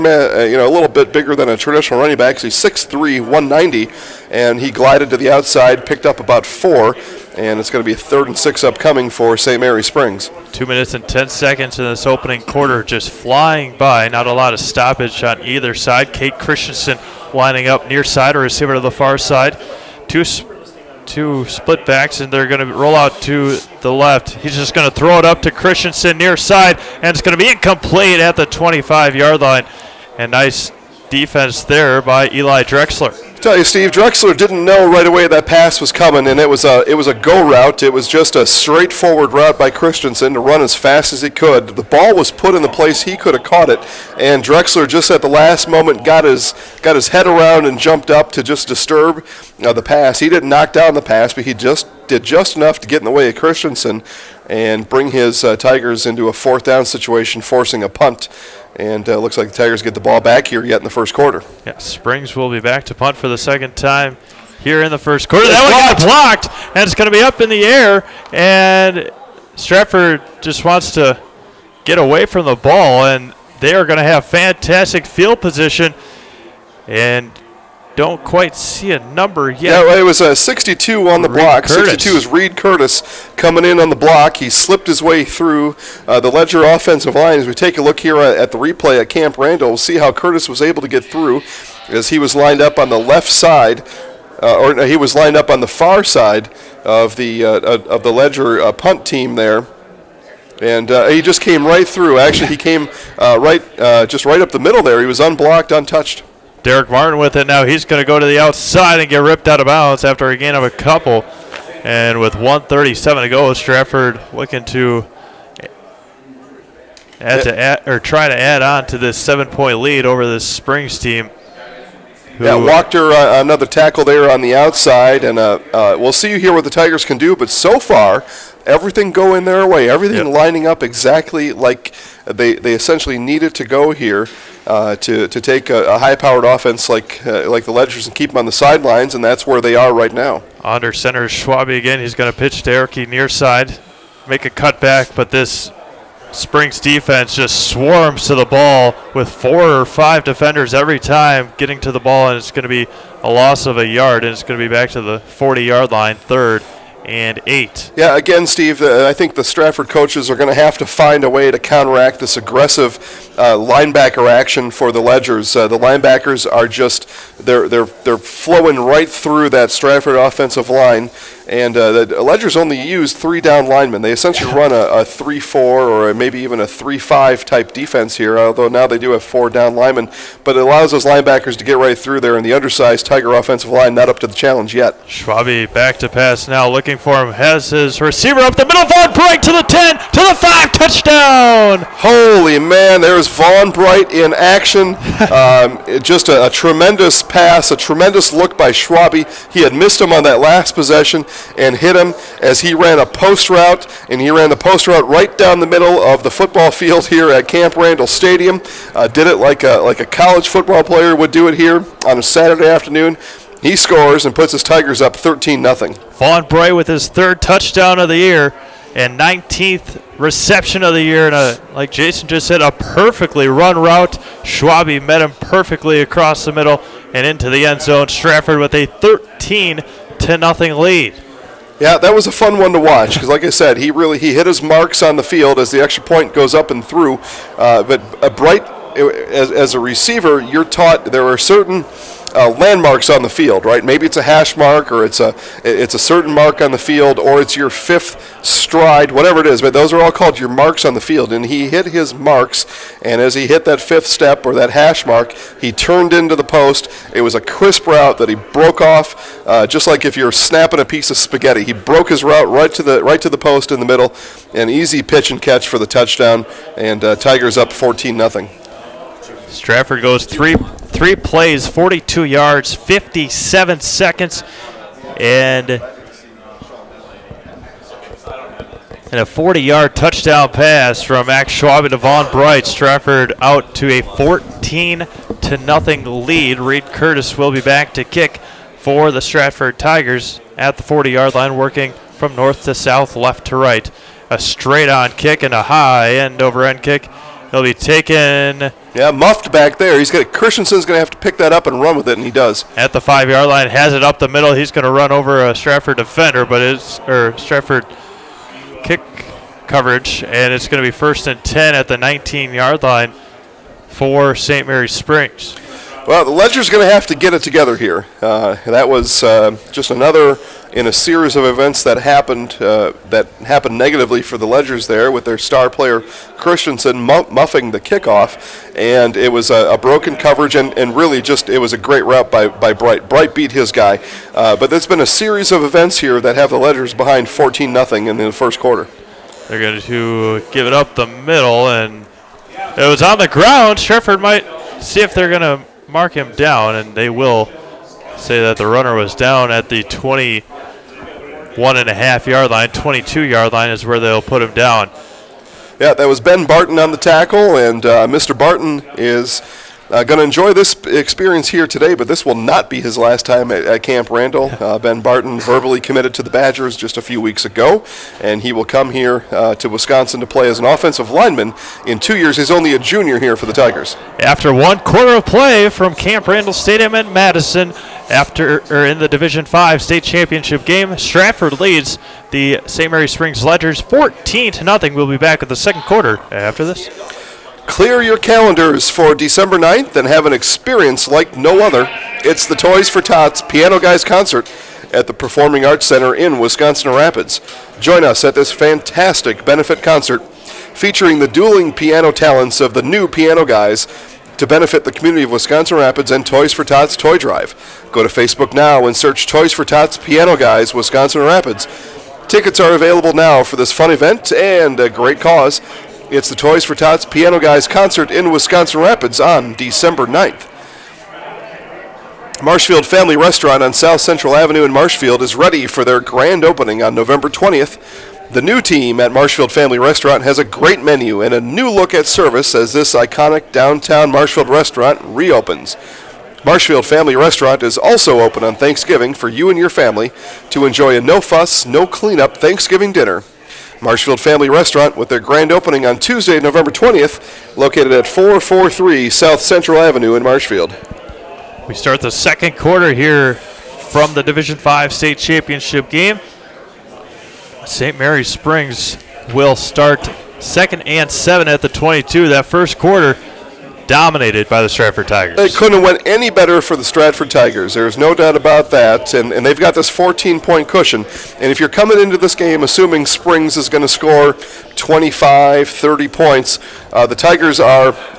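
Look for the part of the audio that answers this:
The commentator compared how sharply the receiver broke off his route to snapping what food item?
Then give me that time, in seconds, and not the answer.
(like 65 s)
261 s.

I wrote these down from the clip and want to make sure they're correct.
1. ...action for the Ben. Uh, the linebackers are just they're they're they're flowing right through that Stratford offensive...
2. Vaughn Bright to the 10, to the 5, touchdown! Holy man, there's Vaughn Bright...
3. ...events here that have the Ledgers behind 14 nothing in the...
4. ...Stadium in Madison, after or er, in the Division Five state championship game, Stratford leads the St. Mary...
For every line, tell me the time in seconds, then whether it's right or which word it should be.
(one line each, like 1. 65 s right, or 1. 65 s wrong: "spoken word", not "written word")
1. 164 s wrong: "Ledgers", not "Ben"
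2. 188 s right
3. 335 s right
4. 376 s right.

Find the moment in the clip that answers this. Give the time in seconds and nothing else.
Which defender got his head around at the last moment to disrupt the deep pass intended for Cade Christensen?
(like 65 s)
32 s.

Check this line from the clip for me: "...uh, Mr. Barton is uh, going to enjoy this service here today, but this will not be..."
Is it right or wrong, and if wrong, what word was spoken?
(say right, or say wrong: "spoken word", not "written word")
wrong: "experience", not "service".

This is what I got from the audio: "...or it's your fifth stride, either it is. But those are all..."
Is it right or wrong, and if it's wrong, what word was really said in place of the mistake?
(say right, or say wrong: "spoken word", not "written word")
wrong: "whatever", not "either".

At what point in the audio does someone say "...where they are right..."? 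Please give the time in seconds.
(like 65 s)
139 s.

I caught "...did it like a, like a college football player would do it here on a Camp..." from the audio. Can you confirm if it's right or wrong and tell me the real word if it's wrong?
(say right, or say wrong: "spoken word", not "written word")
wrong: "Saturday", not "Camp".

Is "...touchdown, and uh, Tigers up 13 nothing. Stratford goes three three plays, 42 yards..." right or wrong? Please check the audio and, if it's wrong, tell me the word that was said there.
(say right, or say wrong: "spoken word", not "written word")
wrong: "14", not "13".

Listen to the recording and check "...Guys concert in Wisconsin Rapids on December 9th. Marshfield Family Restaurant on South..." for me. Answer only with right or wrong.
right.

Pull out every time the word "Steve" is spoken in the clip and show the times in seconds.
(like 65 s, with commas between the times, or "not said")
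33 s, 158 s.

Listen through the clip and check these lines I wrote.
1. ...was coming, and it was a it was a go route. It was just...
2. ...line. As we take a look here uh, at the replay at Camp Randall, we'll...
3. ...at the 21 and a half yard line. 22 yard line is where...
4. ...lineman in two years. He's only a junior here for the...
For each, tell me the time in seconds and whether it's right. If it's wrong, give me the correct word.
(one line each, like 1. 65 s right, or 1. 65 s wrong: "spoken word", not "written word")
1. 35 s right
2. 87 s right
3. 349 s right
4. 371 s right.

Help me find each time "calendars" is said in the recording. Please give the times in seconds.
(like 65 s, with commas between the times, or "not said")
388 s.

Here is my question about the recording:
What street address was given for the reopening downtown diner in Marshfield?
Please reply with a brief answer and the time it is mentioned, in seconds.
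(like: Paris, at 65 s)
443 South Central Avenue, at 448 s.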